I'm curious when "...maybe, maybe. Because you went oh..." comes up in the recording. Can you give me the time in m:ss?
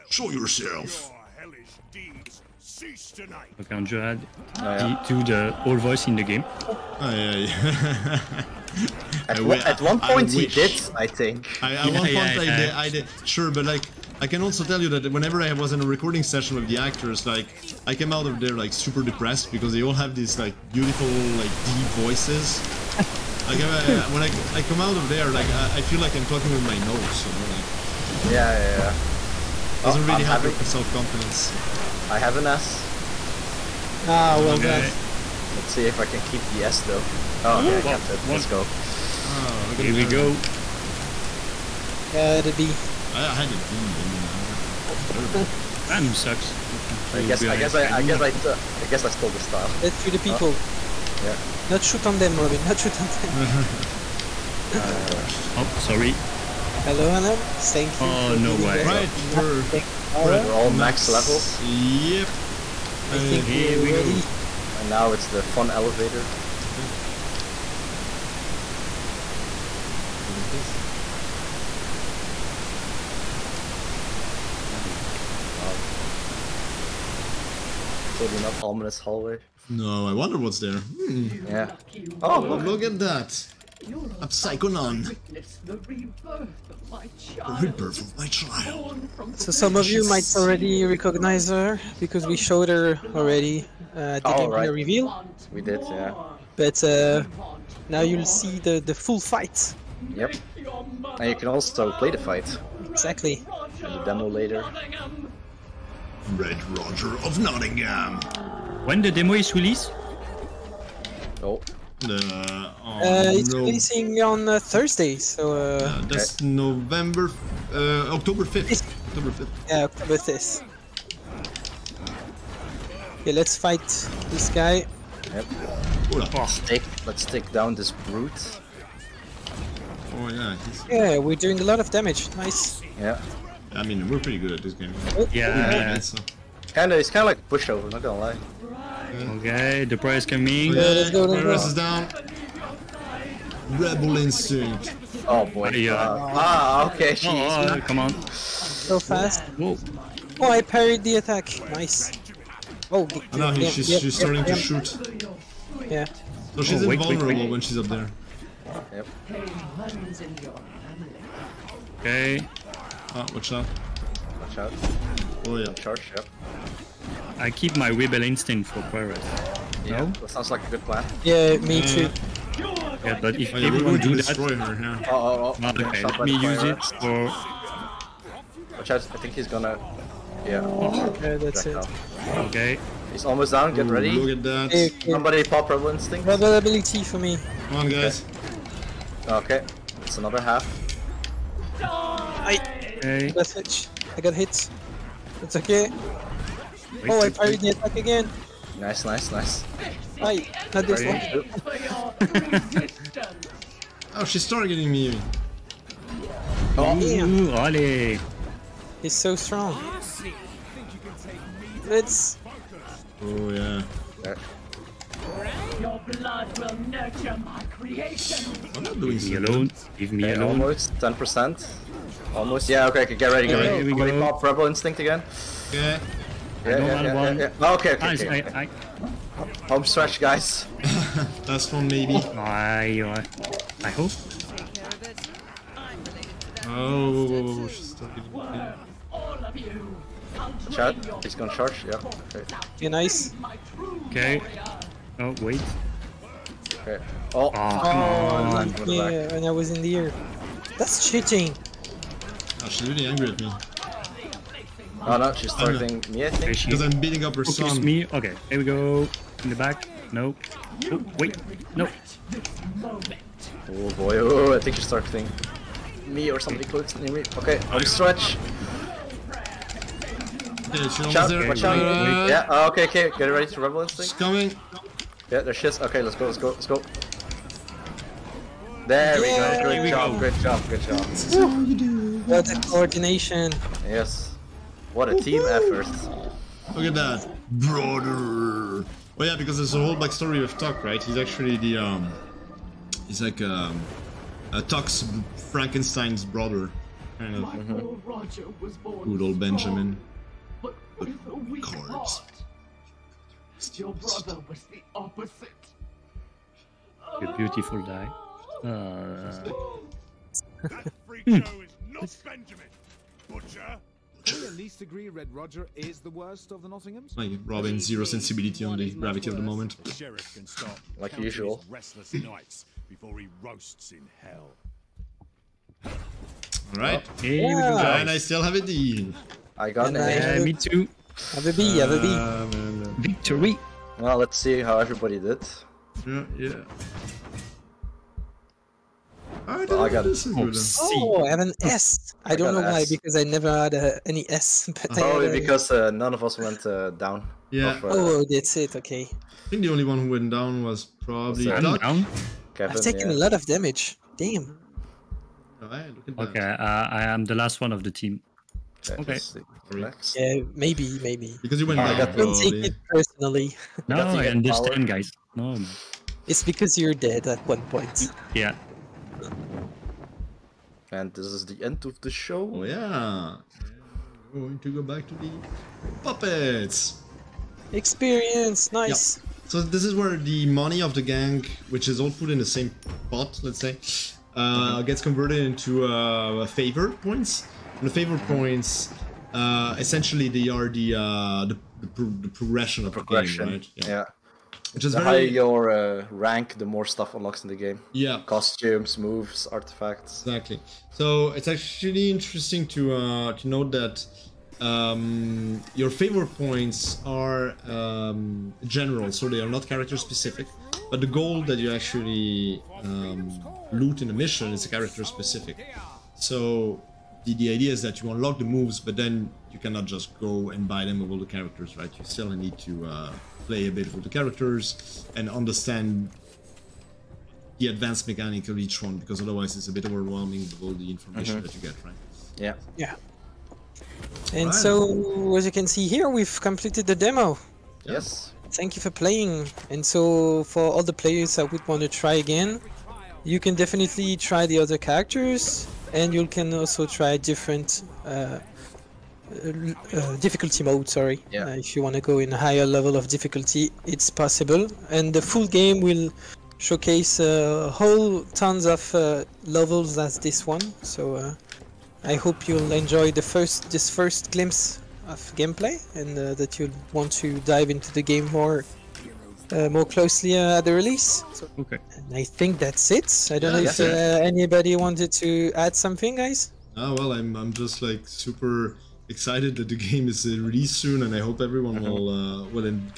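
6:00.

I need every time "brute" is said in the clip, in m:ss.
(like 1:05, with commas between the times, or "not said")
2:07.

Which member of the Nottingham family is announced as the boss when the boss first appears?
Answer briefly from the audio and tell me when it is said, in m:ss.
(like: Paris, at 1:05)
Red Roger of Nottingham, at 1:46.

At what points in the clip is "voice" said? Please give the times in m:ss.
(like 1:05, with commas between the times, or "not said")
0:05, 0:21.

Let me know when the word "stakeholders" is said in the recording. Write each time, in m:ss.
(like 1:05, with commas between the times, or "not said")
not said.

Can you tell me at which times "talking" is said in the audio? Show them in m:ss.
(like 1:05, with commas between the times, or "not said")
0:26.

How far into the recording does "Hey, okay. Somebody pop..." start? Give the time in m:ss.
3:04.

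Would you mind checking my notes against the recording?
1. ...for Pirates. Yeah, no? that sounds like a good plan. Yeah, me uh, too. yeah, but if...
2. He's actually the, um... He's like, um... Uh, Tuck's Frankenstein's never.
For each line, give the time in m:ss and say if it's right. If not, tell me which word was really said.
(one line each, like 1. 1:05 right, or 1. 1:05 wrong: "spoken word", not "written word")
1. 2:48 right
2. 4:51 wrong: "brother", not "never".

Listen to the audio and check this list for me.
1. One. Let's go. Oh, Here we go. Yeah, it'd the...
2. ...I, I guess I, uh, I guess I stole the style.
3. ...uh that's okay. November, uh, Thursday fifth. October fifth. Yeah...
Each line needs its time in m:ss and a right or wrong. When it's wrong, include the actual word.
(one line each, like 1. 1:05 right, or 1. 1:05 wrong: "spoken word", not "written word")
1. 0:38 right
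2. 0:47 right
3. 1:55 wrong: "October", not "Thursday".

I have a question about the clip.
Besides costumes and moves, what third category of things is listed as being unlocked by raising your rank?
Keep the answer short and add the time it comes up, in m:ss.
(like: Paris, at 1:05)
Artifacts, at 6:39.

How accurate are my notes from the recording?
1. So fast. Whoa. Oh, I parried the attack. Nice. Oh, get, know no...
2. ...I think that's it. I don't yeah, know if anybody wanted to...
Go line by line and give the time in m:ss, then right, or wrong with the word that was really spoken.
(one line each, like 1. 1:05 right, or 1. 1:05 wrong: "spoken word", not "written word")
1. 2:28 right
2. 7:52 right.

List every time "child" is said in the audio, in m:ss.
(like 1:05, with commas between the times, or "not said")
1:28.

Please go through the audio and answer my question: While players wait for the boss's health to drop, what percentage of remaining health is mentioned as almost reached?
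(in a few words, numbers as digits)
10%.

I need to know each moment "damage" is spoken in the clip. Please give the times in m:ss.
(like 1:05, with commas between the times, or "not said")
2:11, 5:53.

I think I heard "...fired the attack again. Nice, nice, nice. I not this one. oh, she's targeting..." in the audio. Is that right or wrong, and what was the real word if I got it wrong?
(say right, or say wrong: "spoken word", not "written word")
right.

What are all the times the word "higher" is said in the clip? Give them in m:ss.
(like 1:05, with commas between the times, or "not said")
6:35, 7:32.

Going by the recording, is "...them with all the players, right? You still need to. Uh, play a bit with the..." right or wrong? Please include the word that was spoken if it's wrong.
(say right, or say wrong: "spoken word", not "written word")
wrong: "characters", not "players".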